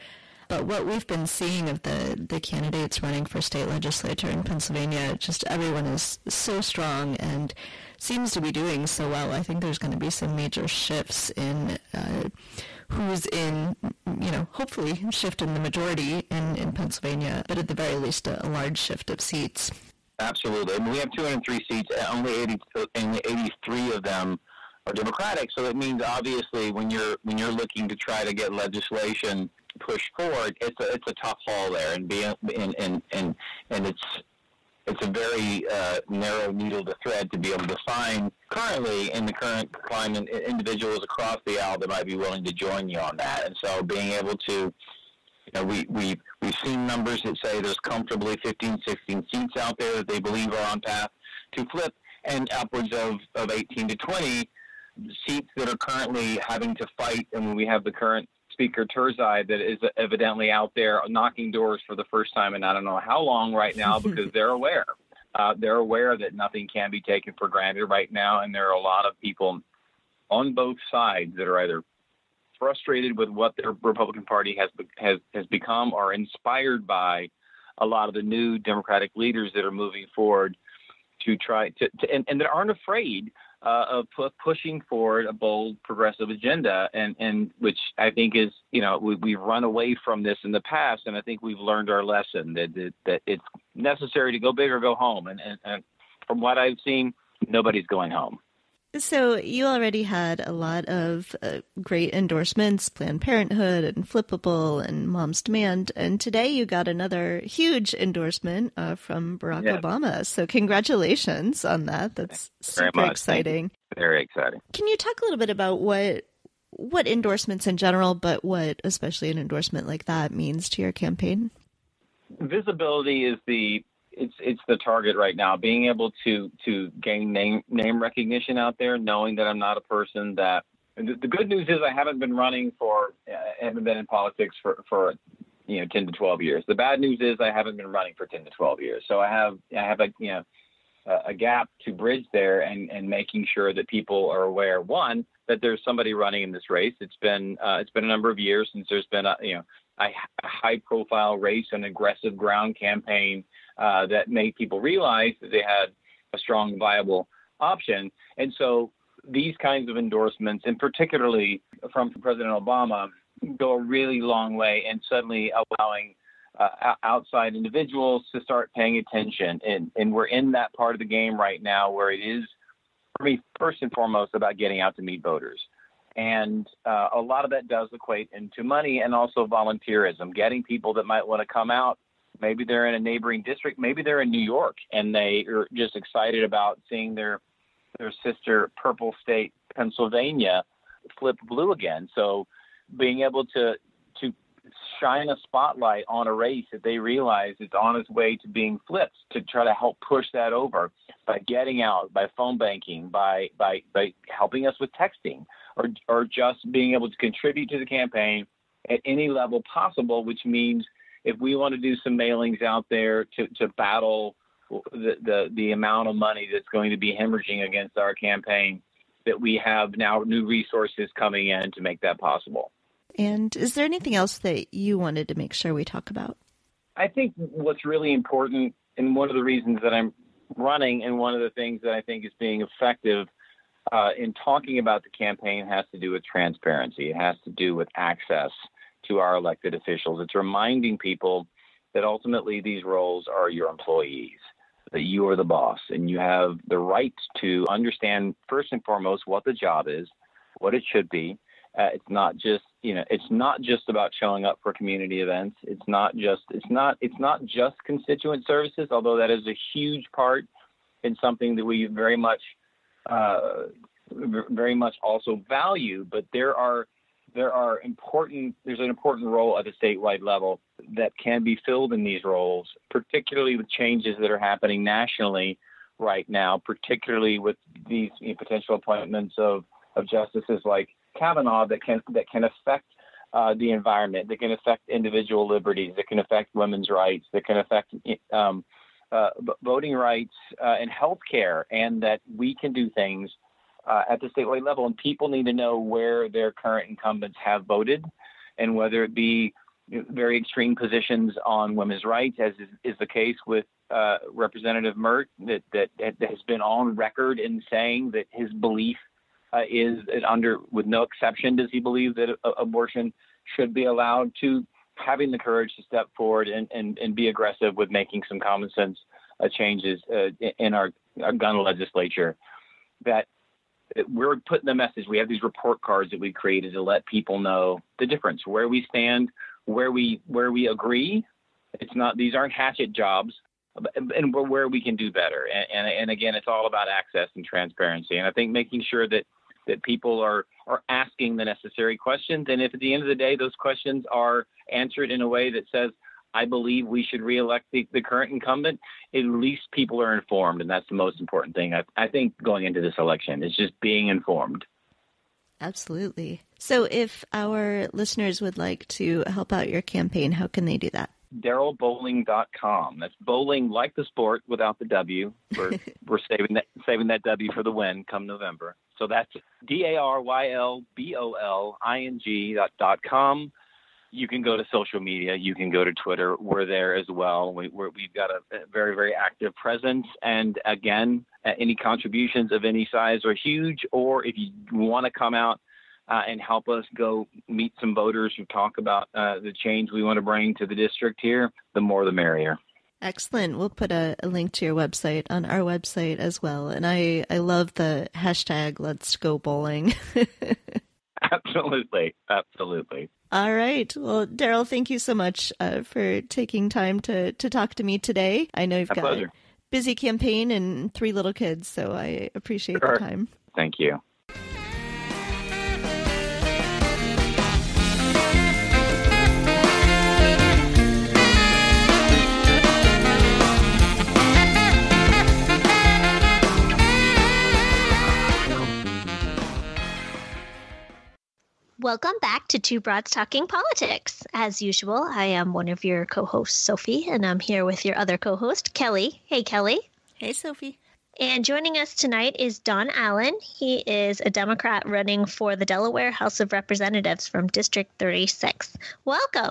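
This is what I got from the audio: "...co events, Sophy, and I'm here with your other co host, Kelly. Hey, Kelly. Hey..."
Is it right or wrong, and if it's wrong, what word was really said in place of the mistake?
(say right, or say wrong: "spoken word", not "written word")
wrong: "hosts", not "events".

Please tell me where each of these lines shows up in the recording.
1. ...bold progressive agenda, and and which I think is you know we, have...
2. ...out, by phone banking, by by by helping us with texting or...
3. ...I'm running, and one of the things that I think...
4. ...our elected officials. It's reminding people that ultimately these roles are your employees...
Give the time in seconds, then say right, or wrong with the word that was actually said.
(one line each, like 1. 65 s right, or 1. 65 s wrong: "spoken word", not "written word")
1. 85 s right
2. 201 s right
3. 229 s right
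4. 239 s right.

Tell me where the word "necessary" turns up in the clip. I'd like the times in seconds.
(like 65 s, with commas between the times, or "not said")
93 s, 341 s.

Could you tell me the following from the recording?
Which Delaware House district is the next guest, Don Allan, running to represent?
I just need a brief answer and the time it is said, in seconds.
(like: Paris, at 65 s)
36, at 447 s.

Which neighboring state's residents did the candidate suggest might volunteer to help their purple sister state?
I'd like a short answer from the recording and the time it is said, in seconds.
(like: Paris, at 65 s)
New York, at 184 s.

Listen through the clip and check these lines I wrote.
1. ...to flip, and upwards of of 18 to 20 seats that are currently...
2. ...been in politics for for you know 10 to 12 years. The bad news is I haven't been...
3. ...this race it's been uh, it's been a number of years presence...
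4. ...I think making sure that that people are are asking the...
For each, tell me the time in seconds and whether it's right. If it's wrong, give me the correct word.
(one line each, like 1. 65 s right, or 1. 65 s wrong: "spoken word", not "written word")
1. 51 s right
2. 133 s right
3. 146 s wrong: "since", not "presence"
4. 338 s right.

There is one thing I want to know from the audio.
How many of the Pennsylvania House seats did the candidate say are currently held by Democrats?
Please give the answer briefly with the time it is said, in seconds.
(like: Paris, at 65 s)
83, at 23 s.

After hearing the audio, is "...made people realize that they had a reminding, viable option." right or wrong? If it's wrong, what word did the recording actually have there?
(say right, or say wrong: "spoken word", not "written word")
wrong: "strong", not "reminding".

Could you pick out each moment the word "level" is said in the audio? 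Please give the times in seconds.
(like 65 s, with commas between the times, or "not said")
209 s, 270 s, 294 s.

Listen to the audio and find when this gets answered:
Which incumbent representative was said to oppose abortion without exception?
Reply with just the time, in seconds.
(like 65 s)
304 s.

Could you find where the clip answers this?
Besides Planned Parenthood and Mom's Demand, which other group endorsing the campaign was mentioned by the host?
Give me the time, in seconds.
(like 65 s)
104 s.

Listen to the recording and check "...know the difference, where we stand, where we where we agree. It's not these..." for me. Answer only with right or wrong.
right.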